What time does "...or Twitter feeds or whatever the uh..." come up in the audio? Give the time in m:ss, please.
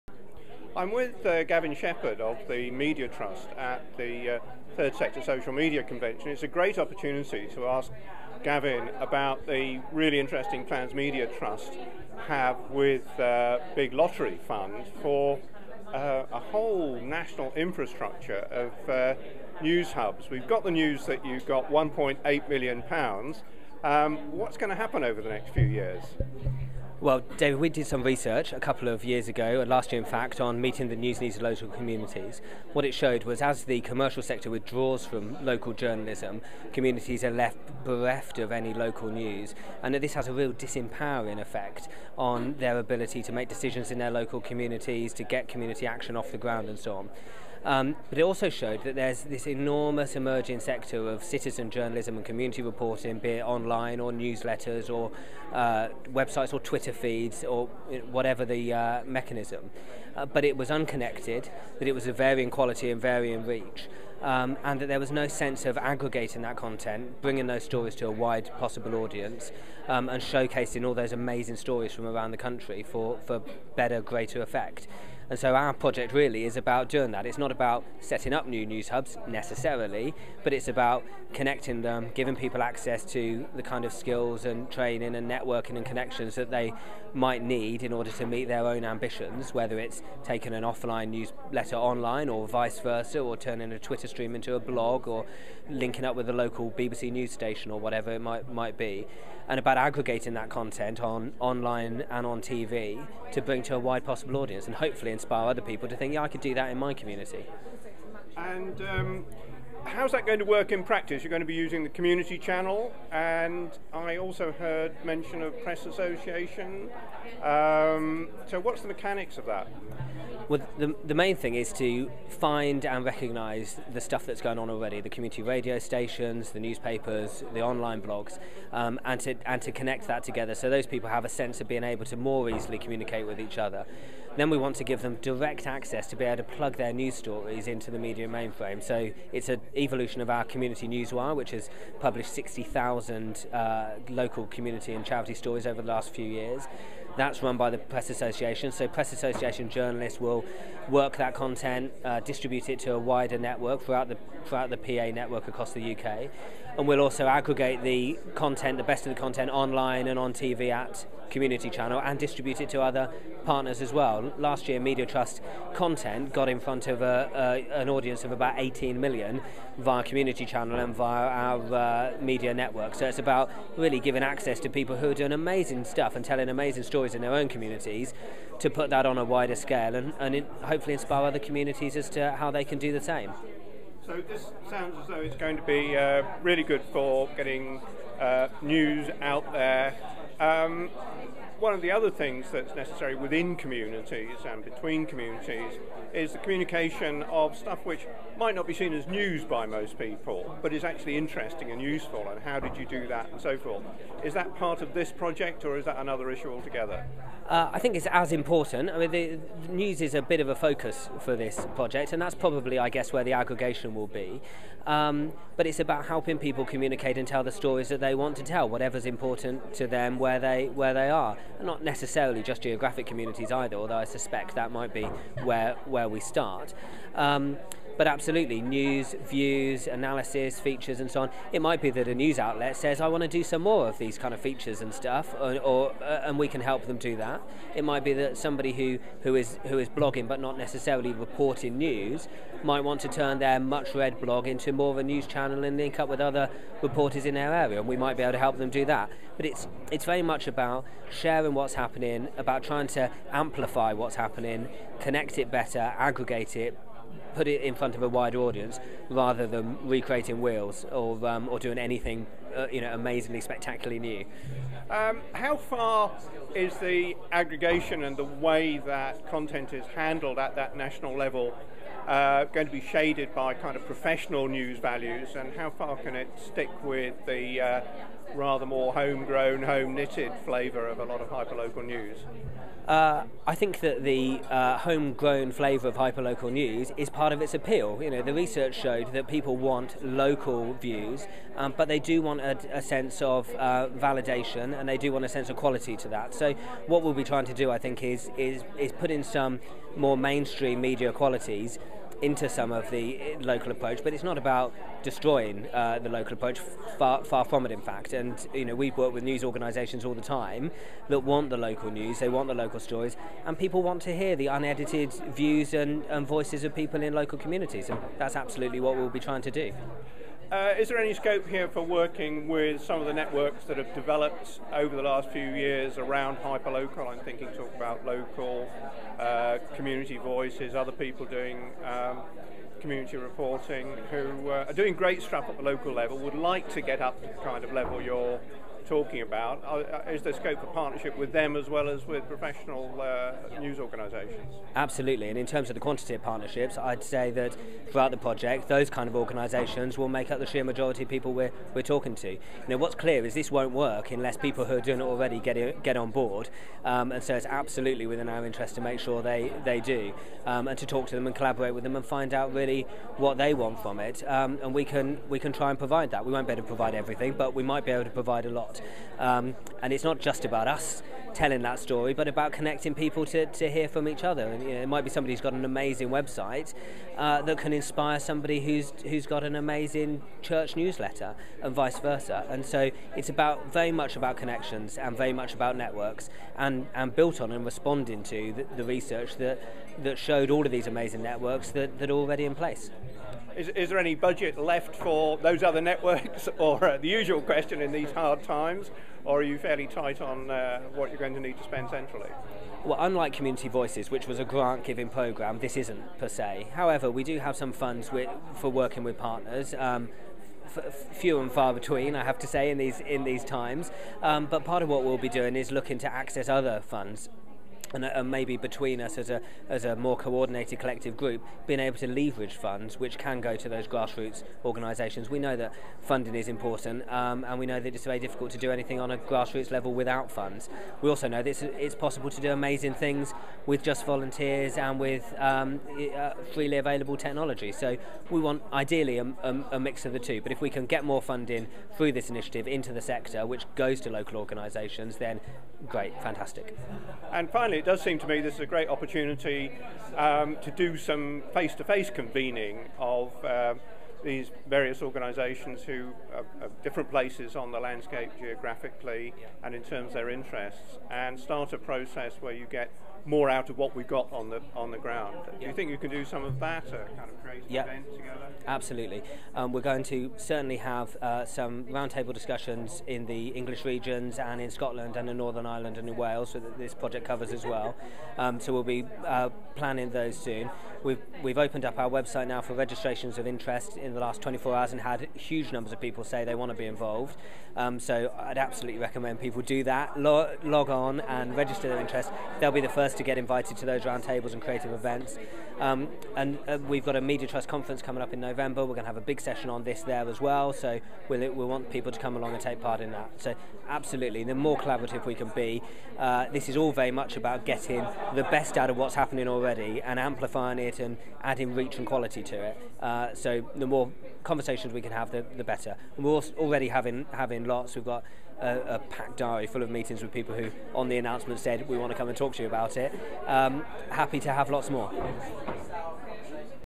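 0:56.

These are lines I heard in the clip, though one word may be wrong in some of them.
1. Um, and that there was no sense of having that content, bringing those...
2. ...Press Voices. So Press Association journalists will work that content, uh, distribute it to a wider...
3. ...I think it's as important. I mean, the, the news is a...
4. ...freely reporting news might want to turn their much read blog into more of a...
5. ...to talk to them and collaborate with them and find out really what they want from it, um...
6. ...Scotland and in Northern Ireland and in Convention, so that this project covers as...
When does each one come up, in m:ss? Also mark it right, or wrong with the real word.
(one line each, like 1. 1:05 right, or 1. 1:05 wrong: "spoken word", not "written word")
1. 1:04 wrong: "aggregating", not "having"
2. 2:27 wrong: "Association", not "Voices"
3. 3:27 right
4. 4:00 wrong: "necessarily", not "freely"
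5. 6:00 right
6. 7:54 wrong: "Wales", not "Convention".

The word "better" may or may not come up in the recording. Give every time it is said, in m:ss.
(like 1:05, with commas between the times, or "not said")
1:13, 4:15, 8:35.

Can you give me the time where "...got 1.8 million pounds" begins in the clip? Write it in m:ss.
0:21.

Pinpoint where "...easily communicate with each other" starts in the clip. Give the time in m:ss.
2:12.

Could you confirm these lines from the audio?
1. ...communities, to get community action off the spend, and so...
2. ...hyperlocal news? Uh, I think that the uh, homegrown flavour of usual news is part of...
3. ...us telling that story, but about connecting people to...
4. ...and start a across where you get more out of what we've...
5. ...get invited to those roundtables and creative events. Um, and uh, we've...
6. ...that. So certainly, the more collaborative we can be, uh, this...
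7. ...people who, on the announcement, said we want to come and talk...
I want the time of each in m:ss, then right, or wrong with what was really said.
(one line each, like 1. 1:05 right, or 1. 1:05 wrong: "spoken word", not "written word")
1. 0:44 wrong: "ground", not "spend"
2. 4:41 wrong: "hyperlocal", not "usual"
3. 6:10 right
4. 7:41 wrong: "process", not "across"
5. 8:13 right
6. 8:23 wrong: "absolutely", not "certainly"
7. 8:40 right.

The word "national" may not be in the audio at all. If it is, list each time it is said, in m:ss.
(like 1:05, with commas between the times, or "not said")
0:17, 4:30.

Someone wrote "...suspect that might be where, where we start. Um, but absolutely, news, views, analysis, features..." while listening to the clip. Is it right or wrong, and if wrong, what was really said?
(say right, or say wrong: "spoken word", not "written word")
right.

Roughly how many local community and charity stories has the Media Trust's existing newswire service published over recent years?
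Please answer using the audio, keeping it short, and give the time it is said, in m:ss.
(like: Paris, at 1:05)
60,000, at 2:22.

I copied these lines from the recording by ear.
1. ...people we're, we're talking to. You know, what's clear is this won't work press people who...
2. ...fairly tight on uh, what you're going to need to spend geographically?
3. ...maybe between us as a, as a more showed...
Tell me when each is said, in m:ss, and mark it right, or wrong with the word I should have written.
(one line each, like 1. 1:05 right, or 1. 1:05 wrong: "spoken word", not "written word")
1. 5:51 wrong: "unless", not "press"
2. 6:39 wrong: "centrally", not "geographically"
3. 6:58 wrong: "coordinated", not "showed".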